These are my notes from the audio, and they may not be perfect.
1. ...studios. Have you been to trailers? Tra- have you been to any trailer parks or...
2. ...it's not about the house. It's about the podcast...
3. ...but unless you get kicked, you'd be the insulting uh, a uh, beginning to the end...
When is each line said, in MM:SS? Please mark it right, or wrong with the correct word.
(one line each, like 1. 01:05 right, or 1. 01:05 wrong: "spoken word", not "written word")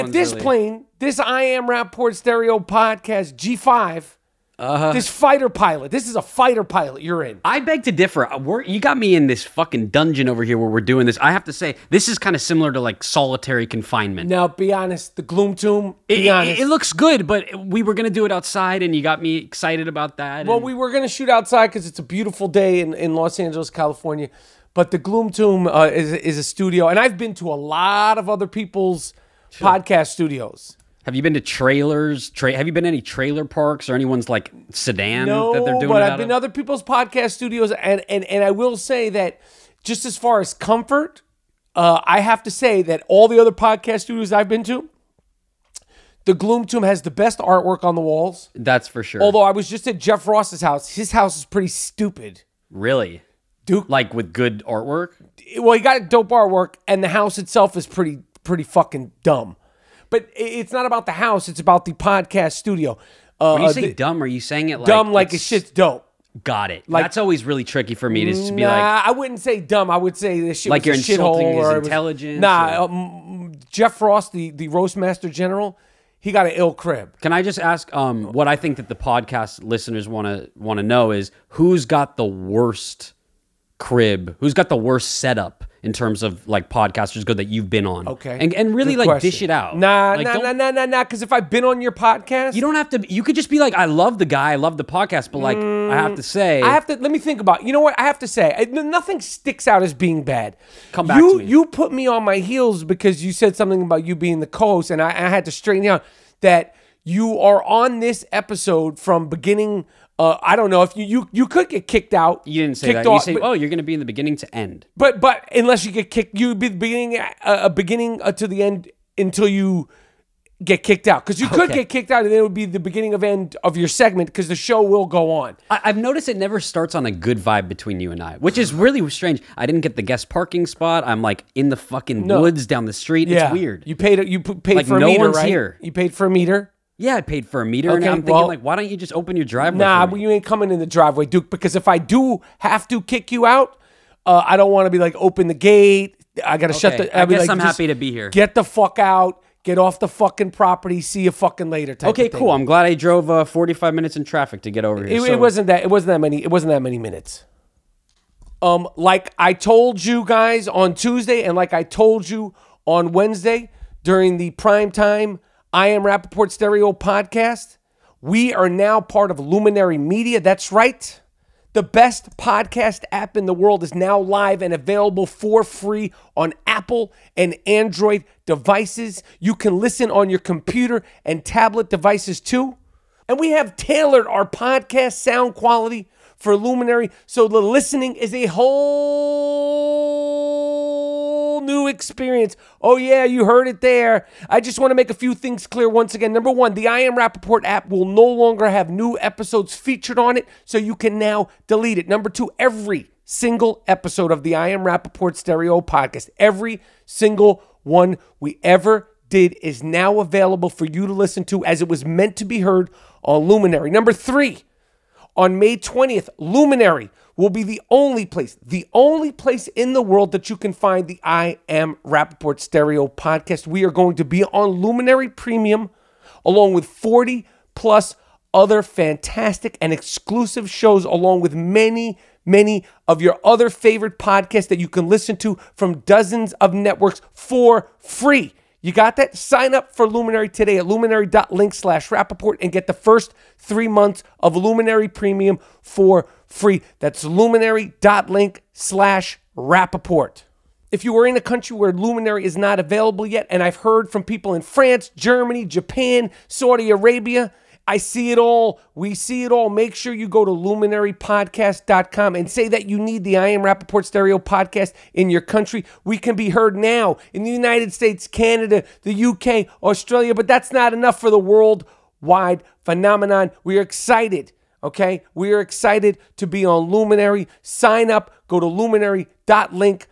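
1. 00:30 right
2. 01:00 right
3. 01:55 wrong: "beginning", not "insulting".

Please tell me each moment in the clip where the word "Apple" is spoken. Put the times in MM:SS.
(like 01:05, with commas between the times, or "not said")
02:56.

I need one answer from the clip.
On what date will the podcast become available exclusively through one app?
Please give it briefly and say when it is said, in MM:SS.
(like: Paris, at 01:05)
May 20th, at 03:35.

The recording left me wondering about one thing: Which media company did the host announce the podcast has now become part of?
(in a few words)
Luminary Media.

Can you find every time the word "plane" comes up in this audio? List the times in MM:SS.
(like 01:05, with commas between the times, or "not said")
00:00.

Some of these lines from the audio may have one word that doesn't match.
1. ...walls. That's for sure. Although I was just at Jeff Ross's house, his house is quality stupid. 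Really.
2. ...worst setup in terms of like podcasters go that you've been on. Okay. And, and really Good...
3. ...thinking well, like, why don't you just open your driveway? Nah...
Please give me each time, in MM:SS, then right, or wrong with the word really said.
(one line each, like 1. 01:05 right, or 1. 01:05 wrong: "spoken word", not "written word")
1. 00:48 wrong: "pretty", not "quality"
2. 01:24 right
3. 02:18 right.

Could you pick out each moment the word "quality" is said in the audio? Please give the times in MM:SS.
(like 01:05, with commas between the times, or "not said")
03:05.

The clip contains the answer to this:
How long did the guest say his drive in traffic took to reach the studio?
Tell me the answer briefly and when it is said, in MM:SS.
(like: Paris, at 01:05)
45 minutes, at 02:33.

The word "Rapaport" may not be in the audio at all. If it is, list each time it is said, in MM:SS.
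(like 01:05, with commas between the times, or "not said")
00:01, 02:46, 03:17, 03:24, 03:42, 04:02, 04:09, 04:23.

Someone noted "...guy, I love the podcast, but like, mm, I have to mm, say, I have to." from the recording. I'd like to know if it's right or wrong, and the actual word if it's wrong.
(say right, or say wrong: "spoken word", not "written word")
right.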